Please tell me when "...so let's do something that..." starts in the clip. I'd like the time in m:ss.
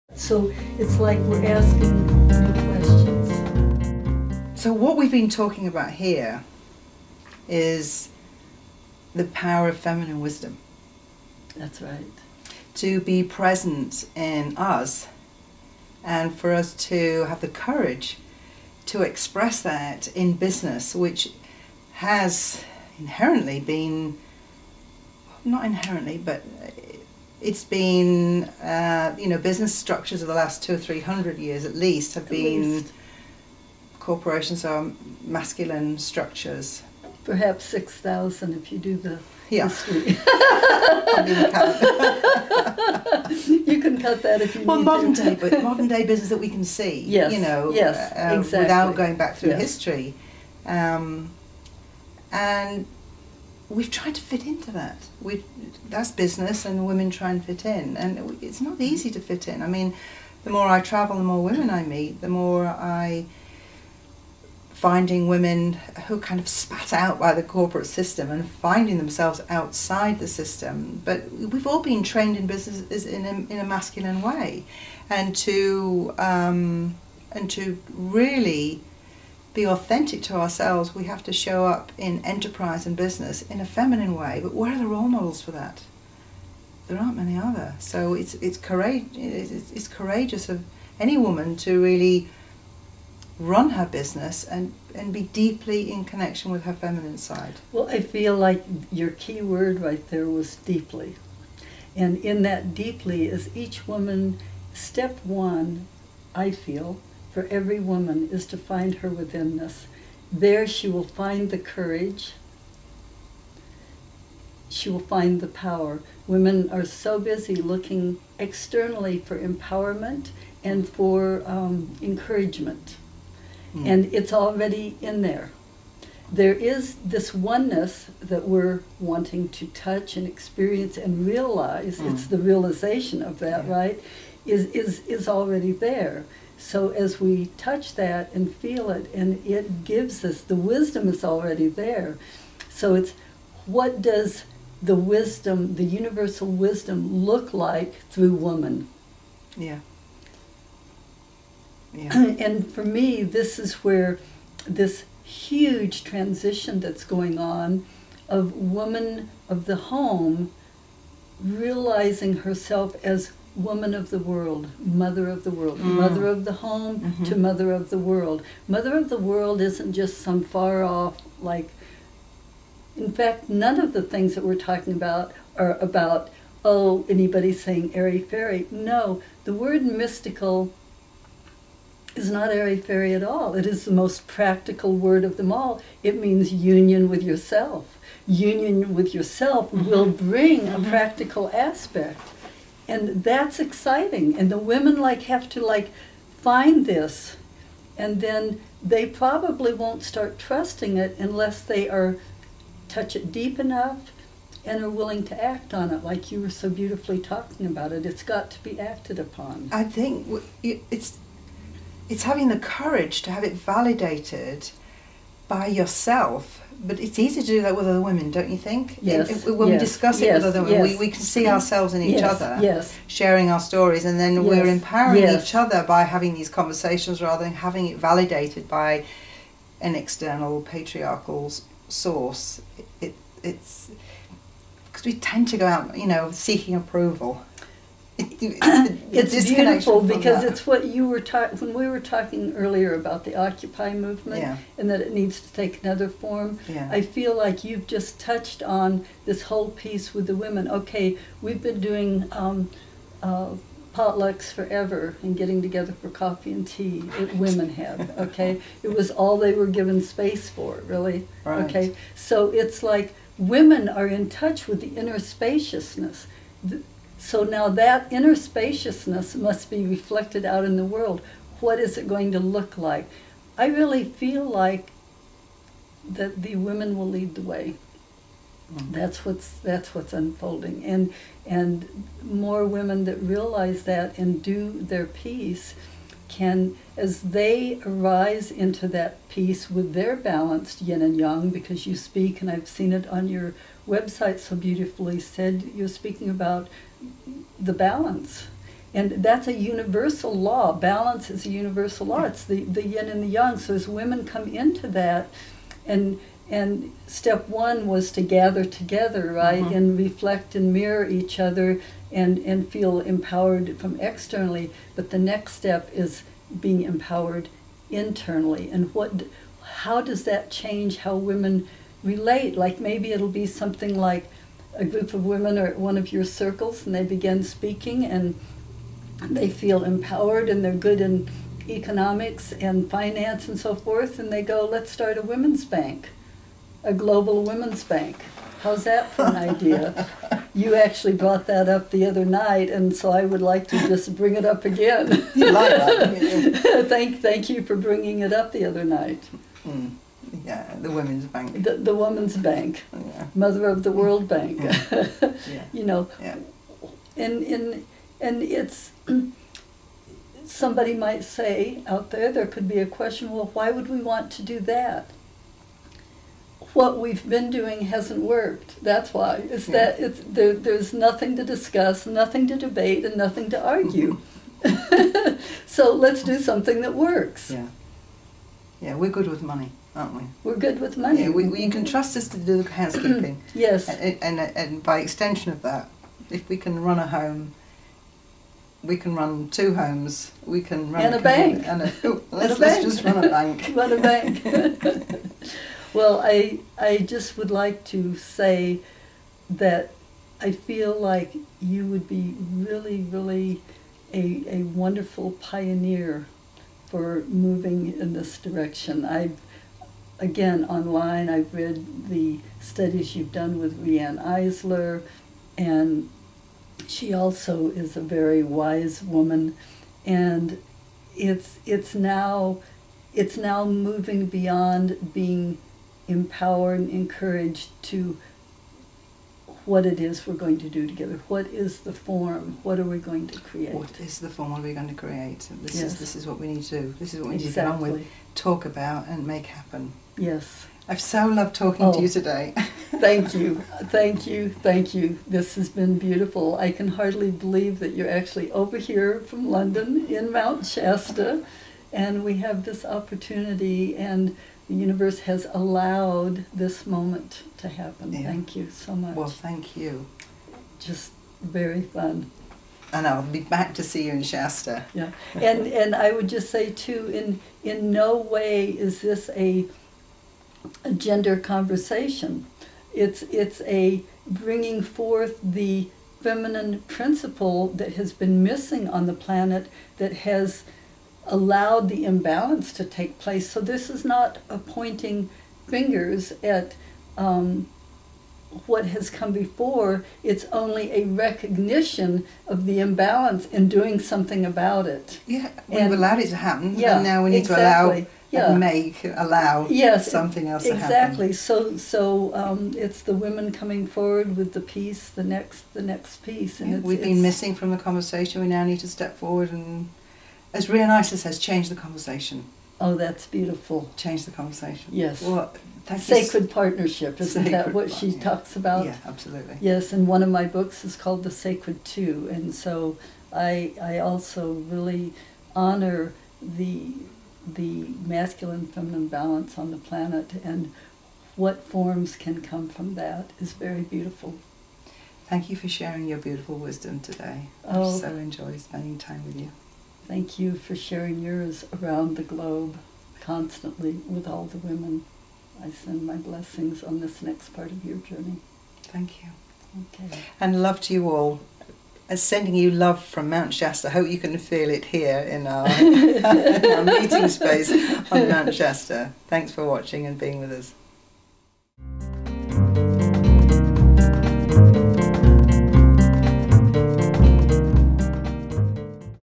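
6:15.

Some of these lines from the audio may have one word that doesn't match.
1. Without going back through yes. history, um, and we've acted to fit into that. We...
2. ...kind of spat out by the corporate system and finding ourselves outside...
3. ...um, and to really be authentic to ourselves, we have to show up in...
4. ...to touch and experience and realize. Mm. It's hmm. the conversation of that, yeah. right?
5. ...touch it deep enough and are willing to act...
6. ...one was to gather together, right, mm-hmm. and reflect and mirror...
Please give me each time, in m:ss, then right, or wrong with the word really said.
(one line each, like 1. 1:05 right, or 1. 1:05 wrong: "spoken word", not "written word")
1. 0:48 wrong: "tried", not "acted"
2. 1:06 wrong: "themselves", not "ourselves"
3. 1:16 right
4. 2:09 wrong: "realization", not "conversation"
5. 3:22 right
6. 5:07 right.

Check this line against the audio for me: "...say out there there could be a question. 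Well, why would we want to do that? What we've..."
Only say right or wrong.
right.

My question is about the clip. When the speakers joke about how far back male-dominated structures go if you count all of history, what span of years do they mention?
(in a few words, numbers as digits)
6000.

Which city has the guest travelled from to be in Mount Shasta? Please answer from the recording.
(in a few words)
London.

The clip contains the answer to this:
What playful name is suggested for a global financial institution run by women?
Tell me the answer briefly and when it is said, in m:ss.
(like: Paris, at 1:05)
Mother of the World Bank, at 5:53.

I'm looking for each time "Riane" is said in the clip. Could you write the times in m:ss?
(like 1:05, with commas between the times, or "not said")
6:53, 8:30.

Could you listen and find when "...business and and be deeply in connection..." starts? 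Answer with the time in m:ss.
1:33.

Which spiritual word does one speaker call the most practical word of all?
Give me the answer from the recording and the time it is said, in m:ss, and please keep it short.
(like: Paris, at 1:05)
mystical, at 2:59.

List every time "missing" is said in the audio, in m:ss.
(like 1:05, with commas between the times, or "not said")
7:58, 8:27.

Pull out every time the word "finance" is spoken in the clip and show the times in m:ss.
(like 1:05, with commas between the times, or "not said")
5:32.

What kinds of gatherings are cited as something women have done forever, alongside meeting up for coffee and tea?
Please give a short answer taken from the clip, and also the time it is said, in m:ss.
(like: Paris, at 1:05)
potlucks, at 4:13.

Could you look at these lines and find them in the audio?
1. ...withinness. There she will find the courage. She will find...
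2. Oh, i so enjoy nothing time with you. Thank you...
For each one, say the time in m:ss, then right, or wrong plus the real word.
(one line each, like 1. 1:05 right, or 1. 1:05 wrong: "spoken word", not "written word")
1. 1:49 right
2. 8:57 wrong: "spending", not "nothing".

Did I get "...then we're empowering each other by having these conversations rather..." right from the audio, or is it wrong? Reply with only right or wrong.
right.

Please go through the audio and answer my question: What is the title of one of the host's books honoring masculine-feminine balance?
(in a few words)
The Sacred Two.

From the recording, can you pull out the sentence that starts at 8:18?
make, allow yes, something else exactly.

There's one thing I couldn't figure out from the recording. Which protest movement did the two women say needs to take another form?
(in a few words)
Occupy movement.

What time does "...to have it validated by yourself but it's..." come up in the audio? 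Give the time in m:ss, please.
3:33.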